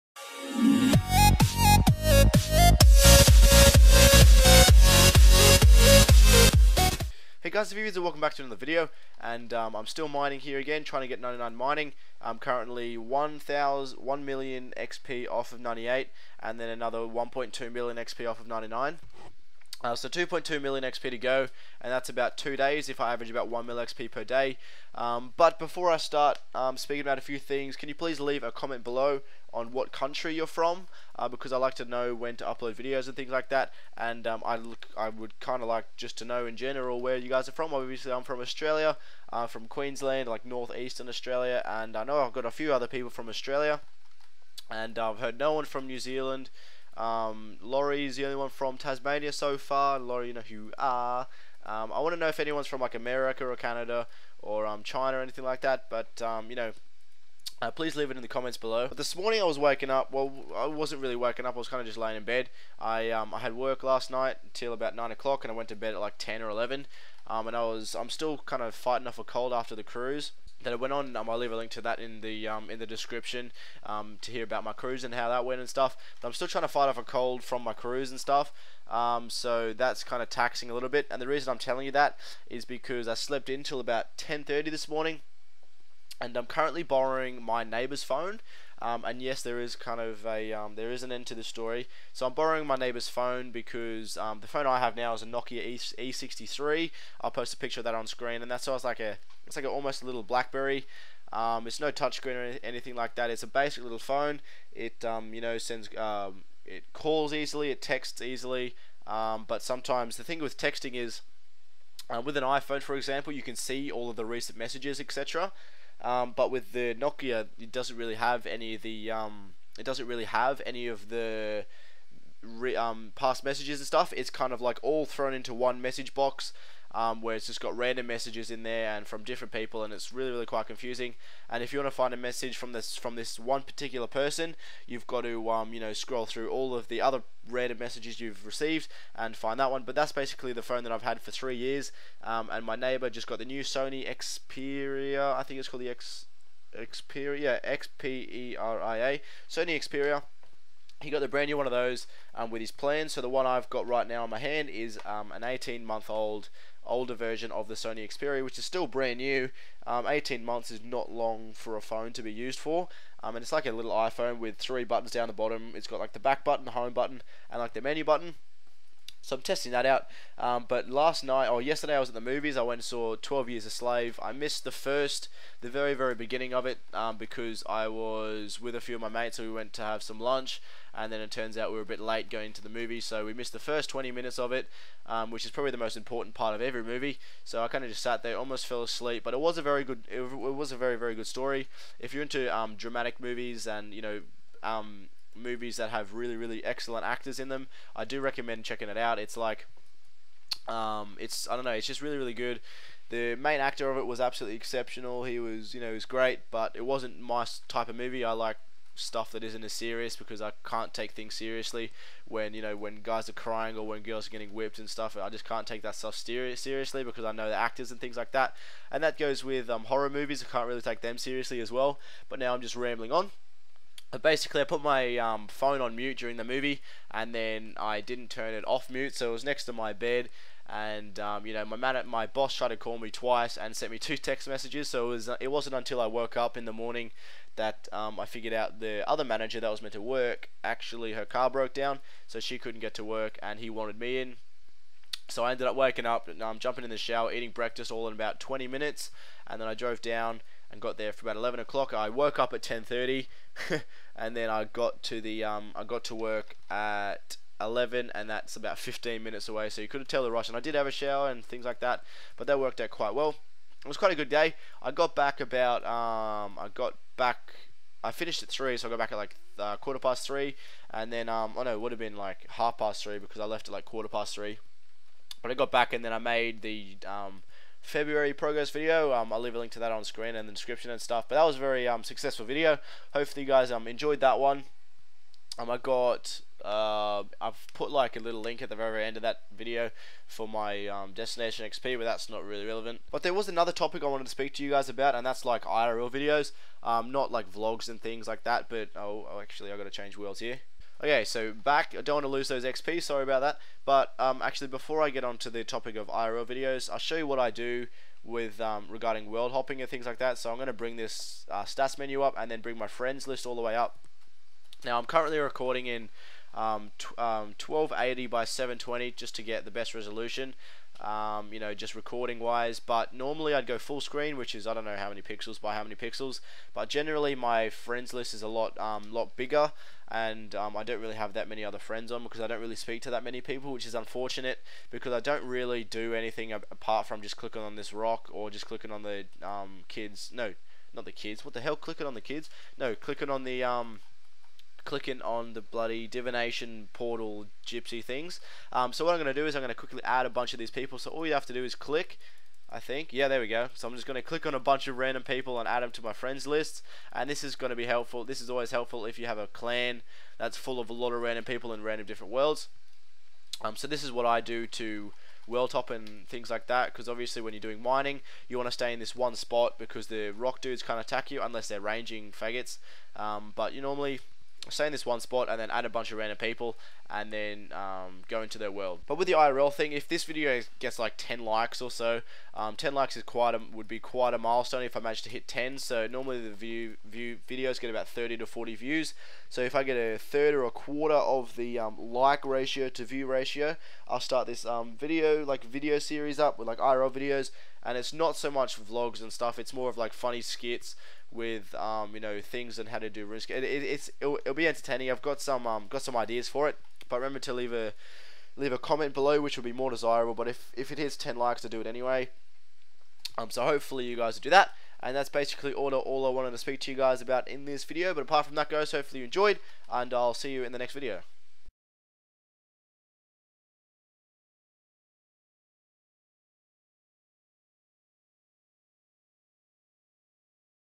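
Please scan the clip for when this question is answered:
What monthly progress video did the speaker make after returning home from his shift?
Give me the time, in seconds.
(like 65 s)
277 s.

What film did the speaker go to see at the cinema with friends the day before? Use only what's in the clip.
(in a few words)
12 Years a Slave.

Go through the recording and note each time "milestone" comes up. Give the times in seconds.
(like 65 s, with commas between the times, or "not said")
384 s.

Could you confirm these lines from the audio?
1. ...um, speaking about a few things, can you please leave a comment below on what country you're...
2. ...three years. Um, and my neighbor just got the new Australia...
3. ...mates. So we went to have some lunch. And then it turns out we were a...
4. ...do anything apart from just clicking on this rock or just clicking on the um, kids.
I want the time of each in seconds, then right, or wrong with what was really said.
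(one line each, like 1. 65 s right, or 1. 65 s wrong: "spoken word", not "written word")
1. 26 s right
2. 141 s wrong: "Sony", not "Australia"
3. 179 s right
4. 335 s right.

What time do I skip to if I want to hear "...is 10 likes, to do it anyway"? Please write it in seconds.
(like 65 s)
410 s.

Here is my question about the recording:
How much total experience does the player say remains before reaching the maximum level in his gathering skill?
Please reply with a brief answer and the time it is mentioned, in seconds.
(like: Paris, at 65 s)
2.2 million XP, at 20 s.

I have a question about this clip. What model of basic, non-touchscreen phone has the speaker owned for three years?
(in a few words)
Nokia E63.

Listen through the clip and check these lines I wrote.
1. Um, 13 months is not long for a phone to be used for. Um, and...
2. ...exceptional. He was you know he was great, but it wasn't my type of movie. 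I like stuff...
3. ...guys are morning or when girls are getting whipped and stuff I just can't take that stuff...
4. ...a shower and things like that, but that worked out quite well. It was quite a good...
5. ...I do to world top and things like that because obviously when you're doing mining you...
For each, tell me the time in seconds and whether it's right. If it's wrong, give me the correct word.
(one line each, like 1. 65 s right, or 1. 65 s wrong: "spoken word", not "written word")
1. 159 s wrong: "18", not "13"
2. 204 s right
3. 213 s wrong: "crying", not "morning"
4. 260 s right
5. 364 s right.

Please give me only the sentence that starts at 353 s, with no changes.
So I'm just going to click on a bunch of random people and add them to my friends list.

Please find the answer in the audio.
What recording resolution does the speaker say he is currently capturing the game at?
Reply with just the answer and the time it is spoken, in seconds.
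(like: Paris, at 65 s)
1280 by 720, at 317 s.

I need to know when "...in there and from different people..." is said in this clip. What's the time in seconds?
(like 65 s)
128 s.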